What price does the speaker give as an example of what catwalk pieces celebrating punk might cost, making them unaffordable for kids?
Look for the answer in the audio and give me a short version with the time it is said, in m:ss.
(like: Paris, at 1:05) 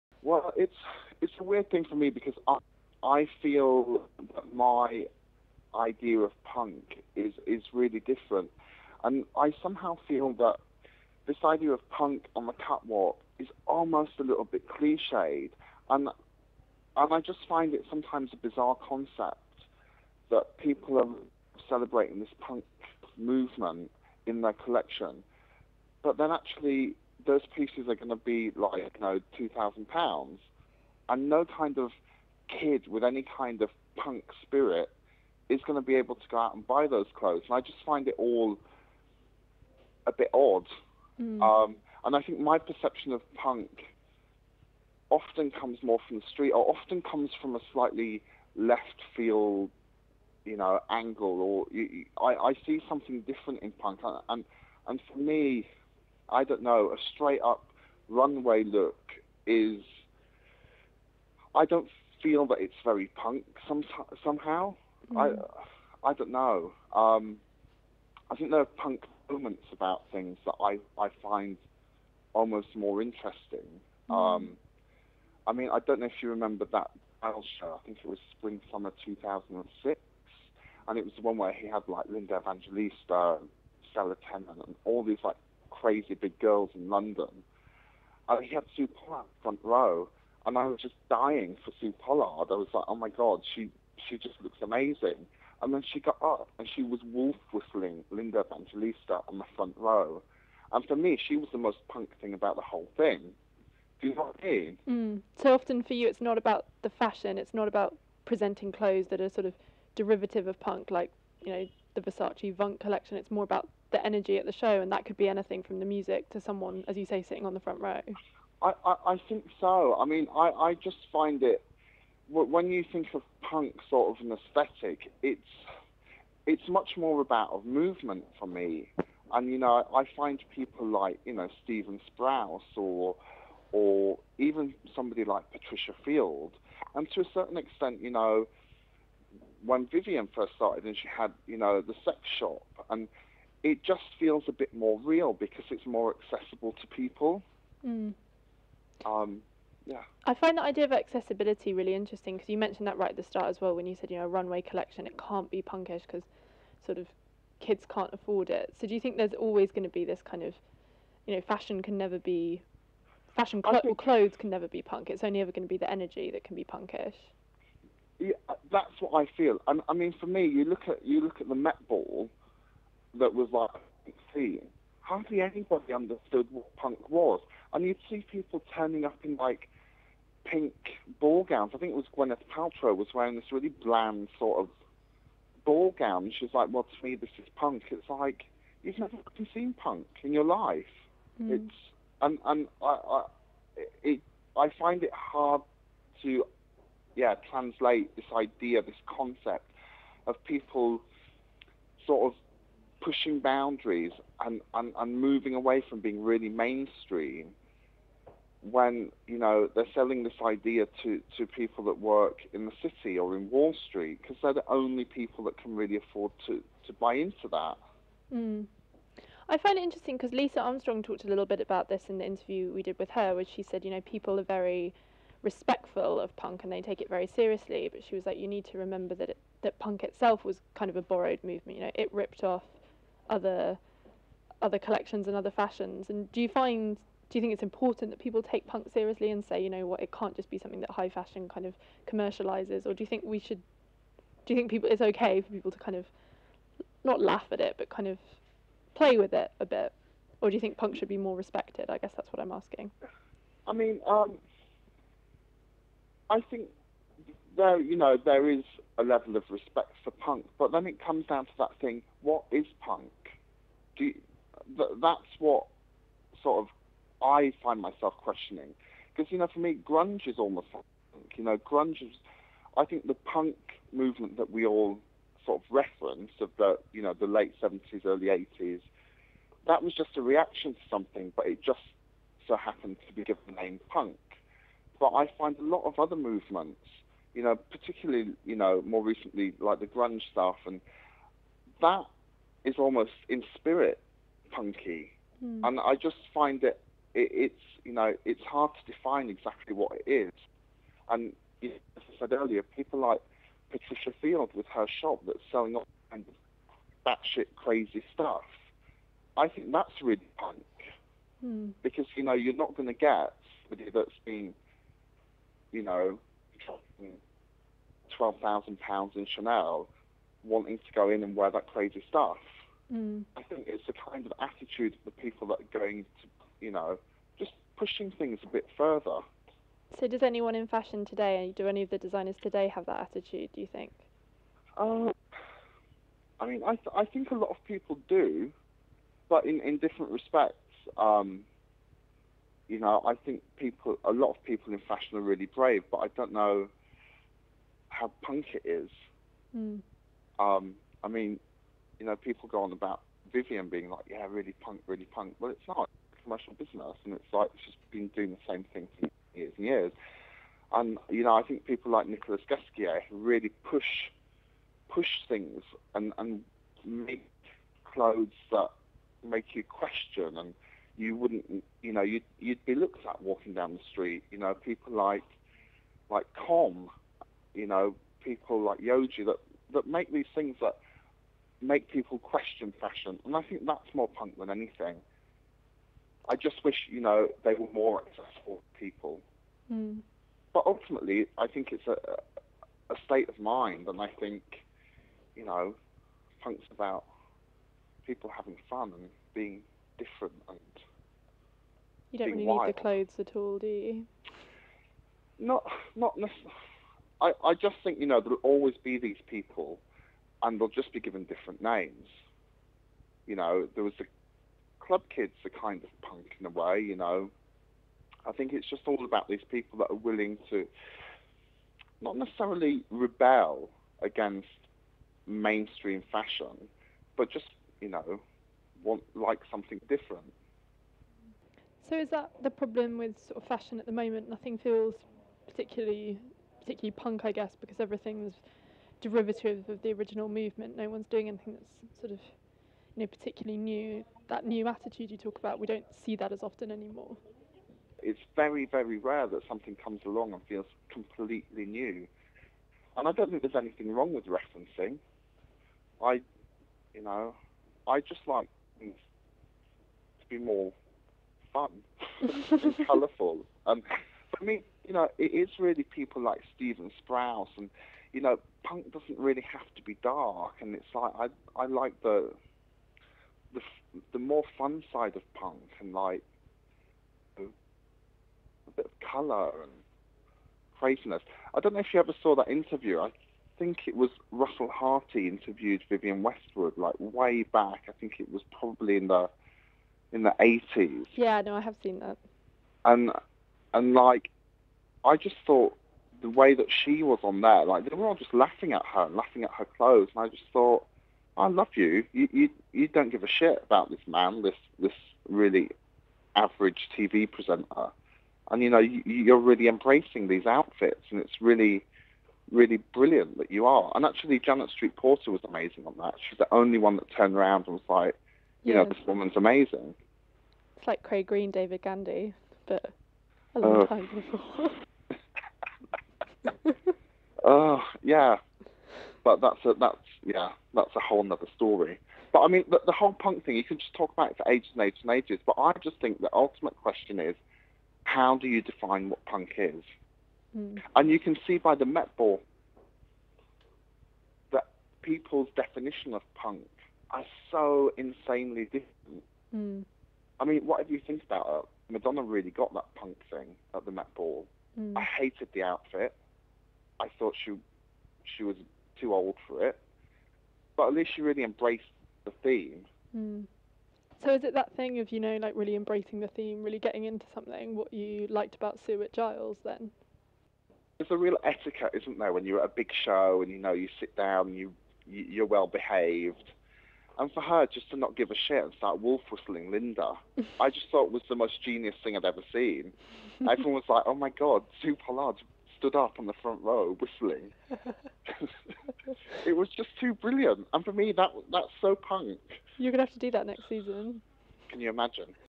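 2000 pounds, at 0:29.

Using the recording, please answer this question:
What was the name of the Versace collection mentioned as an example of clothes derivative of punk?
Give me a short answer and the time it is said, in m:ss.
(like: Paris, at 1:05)
Vunk, at 1:52.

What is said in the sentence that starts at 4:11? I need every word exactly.
I guess that's what I'm asking.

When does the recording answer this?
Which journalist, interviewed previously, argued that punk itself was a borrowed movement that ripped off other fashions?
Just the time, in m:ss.
3:40.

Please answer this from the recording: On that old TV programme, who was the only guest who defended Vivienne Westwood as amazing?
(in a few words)
Janet Street Porter.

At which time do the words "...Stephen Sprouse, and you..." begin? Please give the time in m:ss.
7:46.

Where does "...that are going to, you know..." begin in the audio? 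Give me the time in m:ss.
5:25.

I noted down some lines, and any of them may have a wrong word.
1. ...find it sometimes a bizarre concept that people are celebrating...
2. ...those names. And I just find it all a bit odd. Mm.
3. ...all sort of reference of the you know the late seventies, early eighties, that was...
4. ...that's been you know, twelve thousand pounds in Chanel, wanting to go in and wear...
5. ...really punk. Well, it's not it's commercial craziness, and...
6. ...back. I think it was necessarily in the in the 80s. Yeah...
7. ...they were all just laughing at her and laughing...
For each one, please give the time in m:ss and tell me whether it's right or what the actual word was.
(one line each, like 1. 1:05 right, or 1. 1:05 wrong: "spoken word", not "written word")
1. 0:17 right
2. 0:36 wrong: "clothes", not "names"
3. 4:34 right
4. 5:13 right
5. 5:54 wrong: "business", not "craziness"
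6. 8:07 wrong: "probably", not "necessarily"
7. 8:17 right.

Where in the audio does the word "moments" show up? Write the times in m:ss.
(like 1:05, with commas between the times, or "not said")
1:09, 7:13.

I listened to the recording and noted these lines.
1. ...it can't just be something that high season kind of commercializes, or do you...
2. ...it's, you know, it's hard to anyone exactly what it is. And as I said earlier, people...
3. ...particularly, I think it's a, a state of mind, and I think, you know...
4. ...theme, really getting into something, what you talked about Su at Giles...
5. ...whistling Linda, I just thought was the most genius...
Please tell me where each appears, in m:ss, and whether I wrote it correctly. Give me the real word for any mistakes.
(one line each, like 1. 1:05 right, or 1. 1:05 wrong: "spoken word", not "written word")
1. 4:00 wrong: "fashion", not "season"
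2. 4:57 wrong: "define", not "anyone"
3. 6:30 wrong: "ultimately", not "particularly"
4. 9:26 wrong: "liked", not "talked"
5. 9:39 right.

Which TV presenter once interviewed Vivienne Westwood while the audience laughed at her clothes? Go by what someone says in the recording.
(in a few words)
Russell Harty.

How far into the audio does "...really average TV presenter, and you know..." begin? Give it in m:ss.
8:25.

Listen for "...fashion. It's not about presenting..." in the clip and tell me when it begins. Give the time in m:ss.
1:46.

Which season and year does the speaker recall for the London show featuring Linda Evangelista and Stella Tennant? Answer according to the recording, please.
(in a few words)
spring summer 2006.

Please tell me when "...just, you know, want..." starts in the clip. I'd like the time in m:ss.
7:07.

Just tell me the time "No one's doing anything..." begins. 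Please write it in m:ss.
7:20.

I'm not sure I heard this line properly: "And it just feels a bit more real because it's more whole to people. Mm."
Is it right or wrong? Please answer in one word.
wrong.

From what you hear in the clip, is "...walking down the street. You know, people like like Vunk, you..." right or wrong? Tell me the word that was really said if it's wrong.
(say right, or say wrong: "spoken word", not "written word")
wrong: "Comme", not "Vunk".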